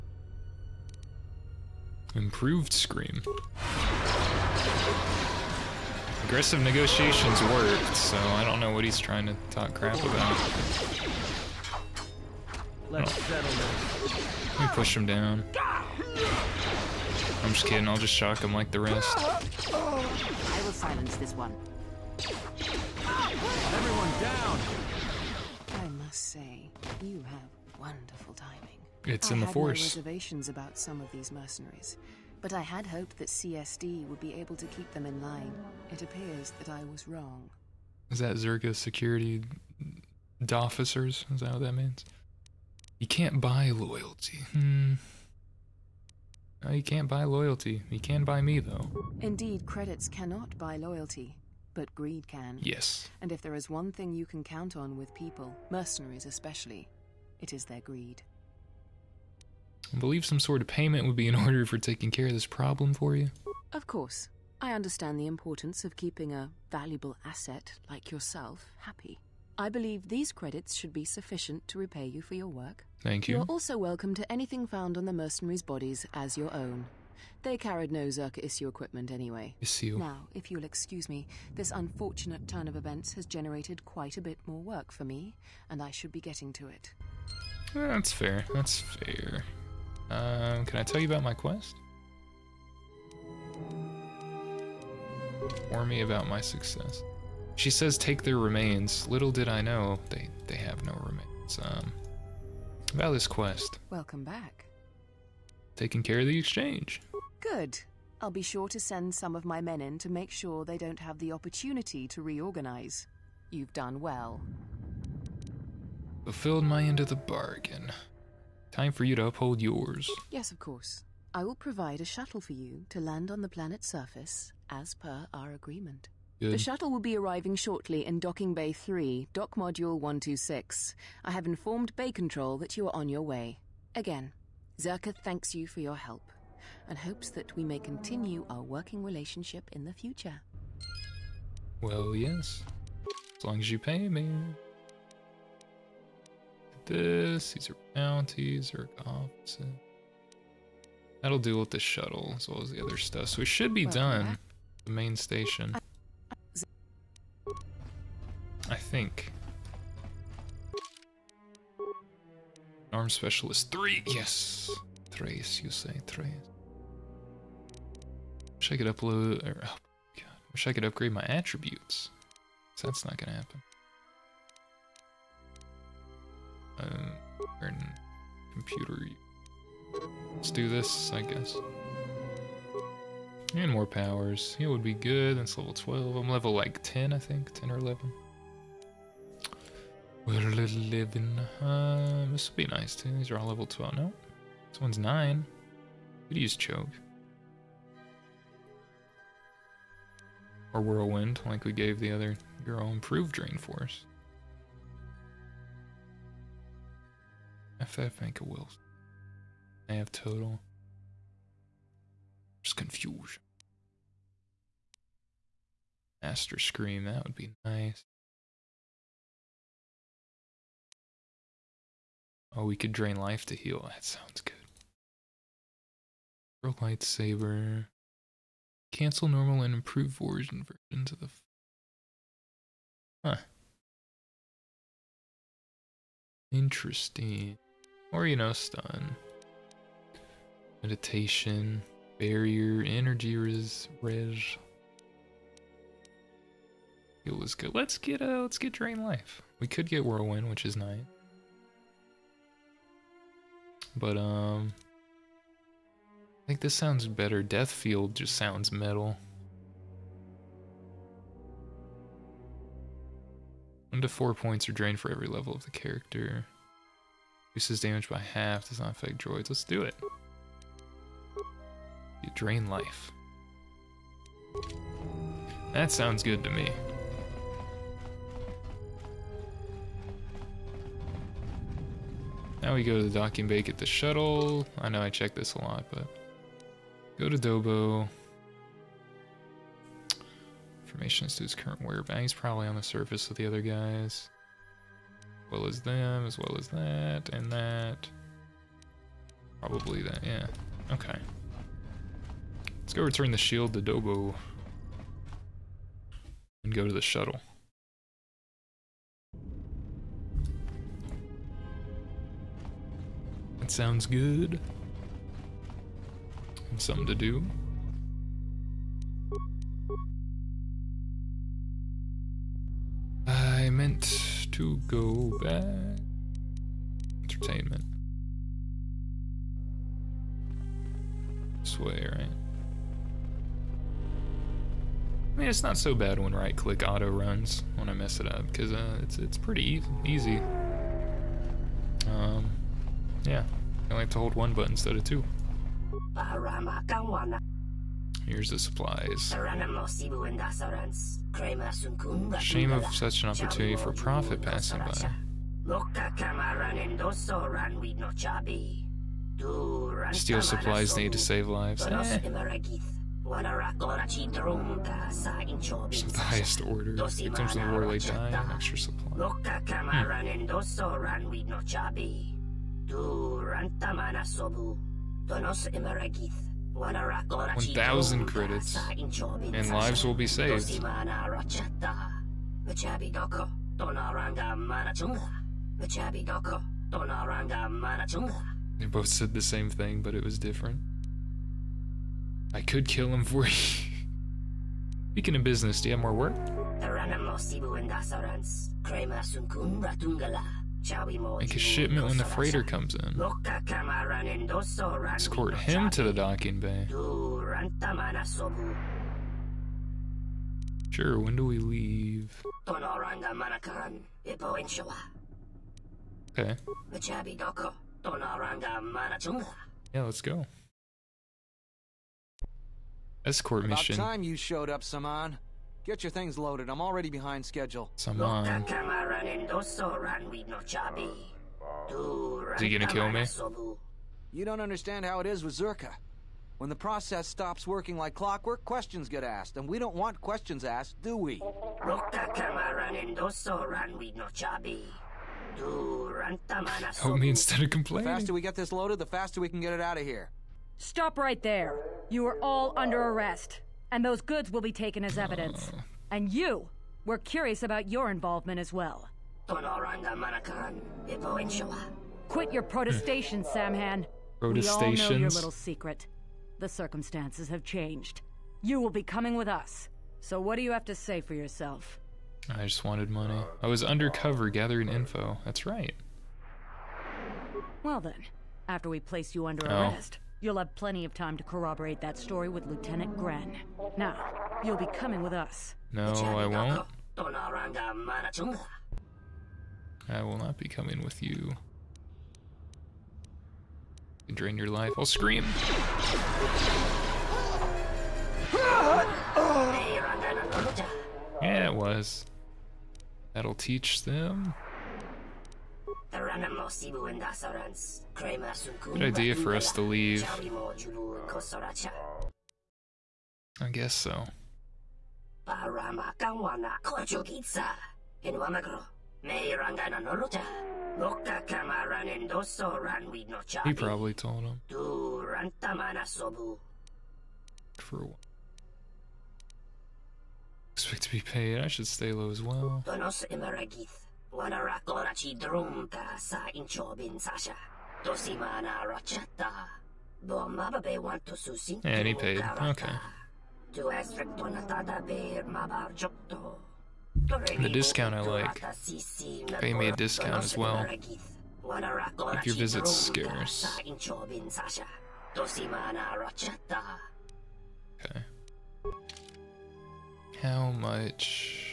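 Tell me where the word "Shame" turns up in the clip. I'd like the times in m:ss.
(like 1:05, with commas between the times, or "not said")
5:52.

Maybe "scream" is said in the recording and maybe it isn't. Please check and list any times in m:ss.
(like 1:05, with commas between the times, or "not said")
0:02, 3:36, 8:15.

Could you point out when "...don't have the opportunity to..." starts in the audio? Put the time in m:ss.
1:50.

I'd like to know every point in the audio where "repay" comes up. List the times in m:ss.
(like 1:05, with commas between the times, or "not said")
1:11.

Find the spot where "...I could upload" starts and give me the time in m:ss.
2:48.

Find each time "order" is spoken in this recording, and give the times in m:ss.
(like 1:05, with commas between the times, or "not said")
1:01, 6:06.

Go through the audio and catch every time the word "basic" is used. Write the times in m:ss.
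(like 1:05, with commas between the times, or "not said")
not said.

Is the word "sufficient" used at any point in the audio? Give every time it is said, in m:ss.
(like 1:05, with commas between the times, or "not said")
1:11.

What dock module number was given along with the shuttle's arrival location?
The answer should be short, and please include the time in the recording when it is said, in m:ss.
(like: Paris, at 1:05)
126, at 2:09.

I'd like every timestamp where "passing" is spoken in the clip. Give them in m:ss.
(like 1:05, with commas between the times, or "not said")
5:54.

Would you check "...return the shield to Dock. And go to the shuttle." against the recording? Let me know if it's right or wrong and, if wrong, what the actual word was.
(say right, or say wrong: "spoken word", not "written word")
wrong: "Dobo", not "Dock".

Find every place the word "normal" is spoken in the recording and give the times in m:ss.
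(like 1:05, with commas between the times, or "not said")
3:49.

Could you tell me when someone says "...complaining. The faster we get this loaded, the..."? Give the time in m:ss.
7:27.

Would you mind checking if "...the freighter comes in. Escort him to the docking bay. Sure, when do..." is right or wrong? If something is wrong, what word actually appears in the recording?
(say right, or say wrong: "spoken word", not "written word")
right.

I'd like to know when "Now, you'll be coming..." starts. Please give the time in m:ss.
8:03.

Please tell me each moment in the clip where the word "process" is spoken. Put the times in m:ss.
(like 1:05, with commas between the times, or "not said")
7:16.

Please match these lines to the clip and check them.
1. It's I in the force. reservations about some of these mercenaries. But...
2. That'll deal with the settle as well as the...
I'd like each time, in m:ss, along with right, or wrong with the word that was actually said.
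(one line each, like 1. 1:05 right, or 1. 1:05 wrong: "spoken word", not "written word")
1. 0:29 right
2. 2:31 wrong: "shuttle", not "settle".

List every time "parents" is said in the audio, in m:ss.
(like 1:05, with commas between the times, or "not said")
not said.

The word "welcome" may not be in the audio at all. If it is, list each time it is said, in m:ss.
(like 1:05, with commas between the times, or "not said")
1:13, 1:43.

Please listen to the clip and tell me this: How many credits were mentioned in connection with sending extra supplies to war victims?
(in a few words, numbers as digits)
1,000 credits.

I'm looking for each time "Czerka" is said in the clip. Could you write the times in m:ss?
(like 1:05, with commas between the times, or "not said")
0:38, 1:18, 2:14, 7:15.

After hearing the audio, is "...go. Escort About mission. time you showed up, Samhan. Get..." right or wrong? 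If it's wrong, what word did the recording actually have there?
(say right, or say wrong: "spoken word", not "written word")
right.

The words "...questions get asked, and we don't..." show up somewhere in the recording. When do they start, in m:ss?
7:18.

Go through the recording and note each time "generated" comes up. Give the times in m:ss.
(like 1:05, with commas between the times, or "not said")
1:23.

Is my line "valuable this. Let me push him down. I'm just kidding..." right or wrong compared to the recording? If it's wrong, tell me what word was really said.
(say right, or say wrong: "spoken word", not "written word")
wrong: "settle", not "valuable".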